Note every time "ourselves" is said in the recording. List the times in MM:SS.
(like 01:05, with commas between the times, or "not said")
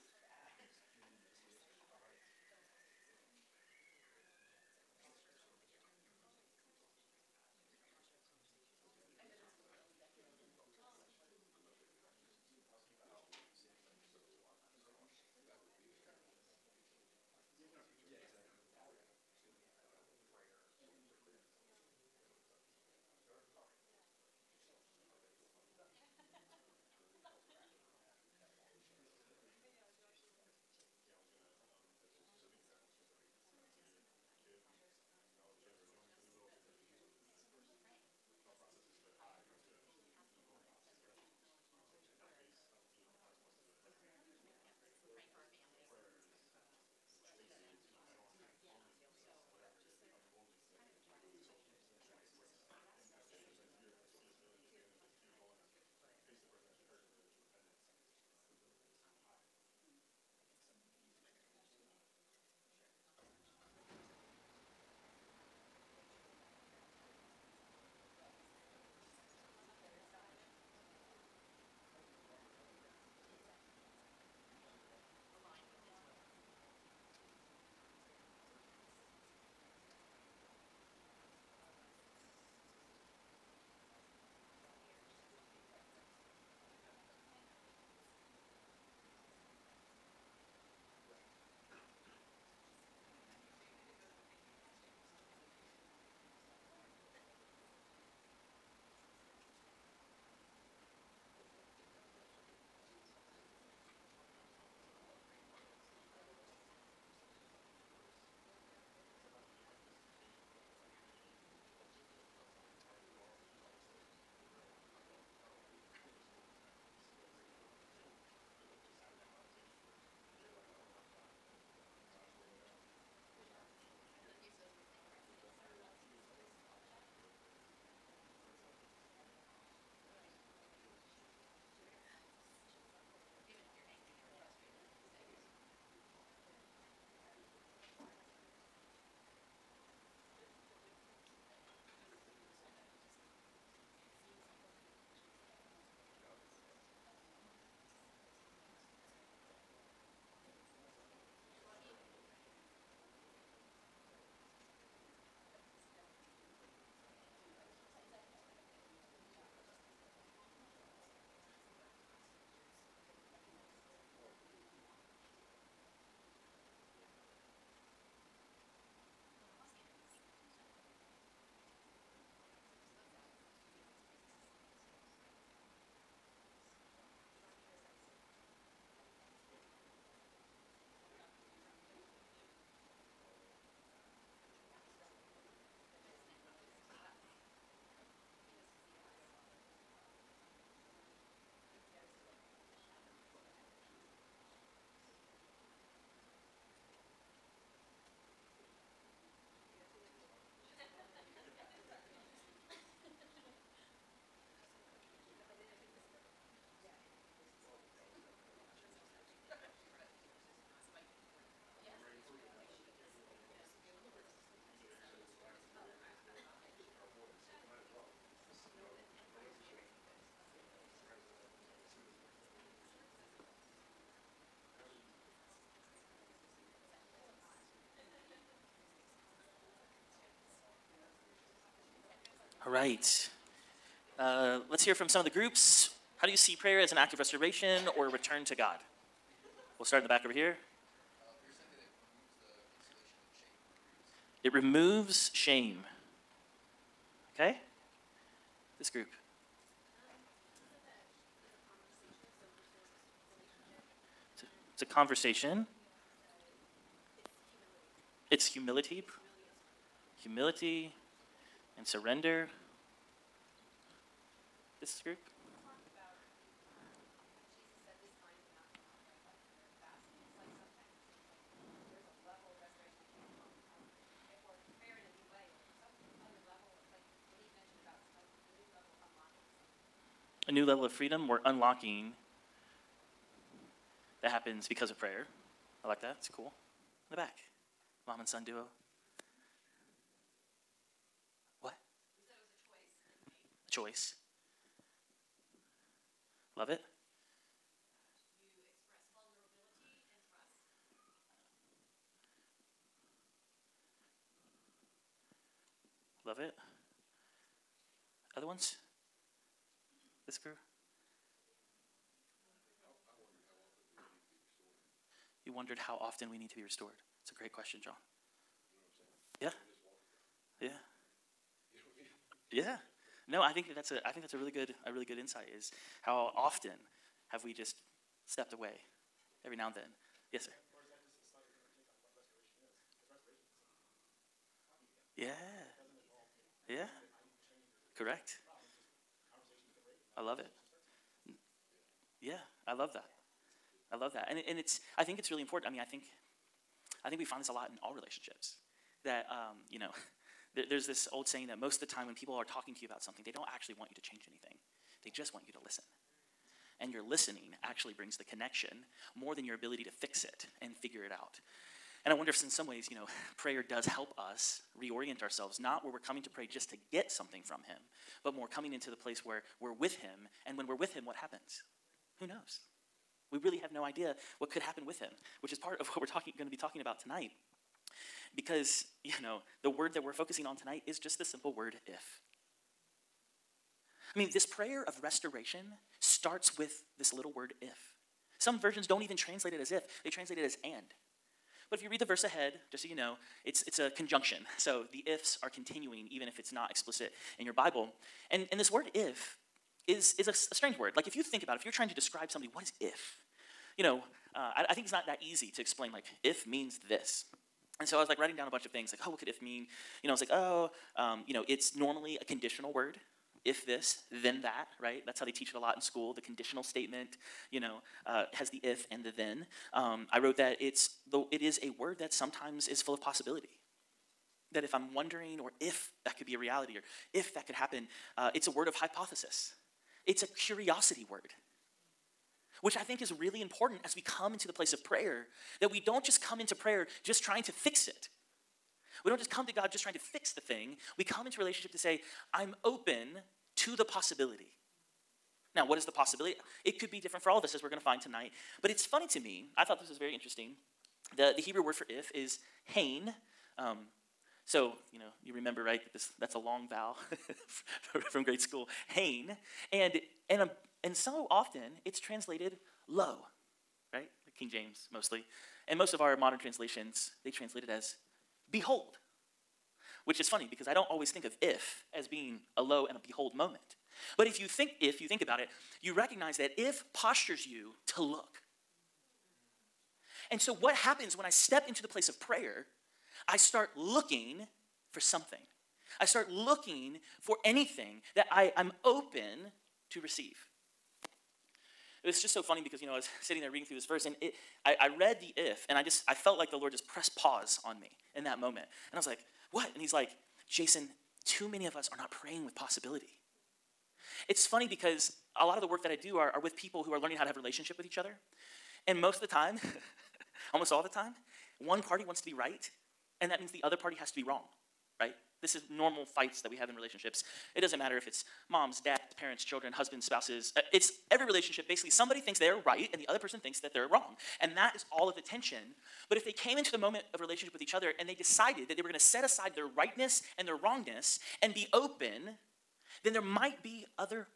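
06:05.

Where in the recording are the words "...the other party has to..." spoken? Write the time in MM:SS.
08:33.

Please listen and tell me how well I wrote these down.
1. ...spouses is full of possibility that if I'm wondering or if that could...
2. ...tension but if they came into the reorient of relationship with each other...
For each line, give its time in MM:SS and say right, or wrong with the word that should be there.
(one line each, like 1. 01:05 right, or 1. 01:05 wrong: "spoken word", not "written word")
1. 07:02 wrong: "sometimes", not "spouses"
2. 08:45 wrong: "moment", not "reorient".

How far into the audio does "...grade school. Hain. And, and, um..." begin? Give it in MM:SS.
07:38.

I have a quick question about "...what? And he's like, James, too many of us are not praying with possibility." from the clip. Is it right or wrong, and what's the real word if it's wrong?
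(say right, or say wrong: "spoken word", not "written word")
wrong: "Jason", not "James".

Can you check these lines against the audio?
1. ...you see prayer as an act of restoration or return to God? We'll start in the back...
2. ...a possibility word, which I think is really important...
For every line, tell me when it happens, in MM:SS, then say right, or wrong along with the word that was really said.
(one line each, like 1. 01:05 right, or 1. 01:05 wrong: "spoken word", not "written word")
1. 03:56 right
2. 07:10 wrong: "curiosity", not "possibility".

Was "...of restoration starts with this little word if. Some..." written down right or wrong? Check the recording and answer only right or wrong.
right.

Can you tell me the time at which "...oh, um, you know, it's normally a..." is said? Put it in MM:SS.
06:50.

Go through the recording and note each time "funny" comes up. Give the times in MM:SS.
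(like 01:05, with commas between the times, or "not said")
07:28, 07:50, 08:12, 08:24.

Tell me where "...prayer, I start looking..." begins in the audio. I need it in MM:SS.
08:02.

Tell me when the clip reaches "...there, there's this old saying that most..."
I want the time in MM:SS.
05:50.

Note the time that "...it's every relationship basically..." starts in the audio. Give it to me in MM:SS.
08:40.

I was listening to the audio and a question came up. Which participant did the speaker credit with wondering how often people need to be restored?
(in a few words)
John.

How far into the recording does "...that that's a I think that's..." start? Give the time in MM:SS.
05:23.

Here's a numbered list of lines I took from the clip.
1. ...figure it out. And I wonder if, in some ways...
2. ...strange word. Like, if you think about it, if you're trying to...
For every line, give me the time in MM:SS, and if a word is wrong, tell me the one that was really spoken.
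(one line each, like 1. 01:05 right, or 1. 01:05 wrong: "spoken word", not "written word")
1. 06:00 right
2. 06:40 right.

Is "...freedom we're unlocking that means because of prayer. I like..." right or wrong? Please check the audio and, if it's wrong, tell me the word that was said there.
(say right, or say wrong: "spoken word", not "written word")
wrong: "happens", not "means".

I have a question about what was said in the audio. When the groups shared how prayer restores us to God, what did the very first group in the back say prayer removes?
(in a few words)
Shame.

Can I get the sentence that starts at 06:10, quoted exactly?
And when we're with Him, what happens?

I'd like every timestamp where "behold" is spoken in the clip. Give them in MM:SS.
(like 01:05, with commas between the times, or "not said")
07:48, 07:53.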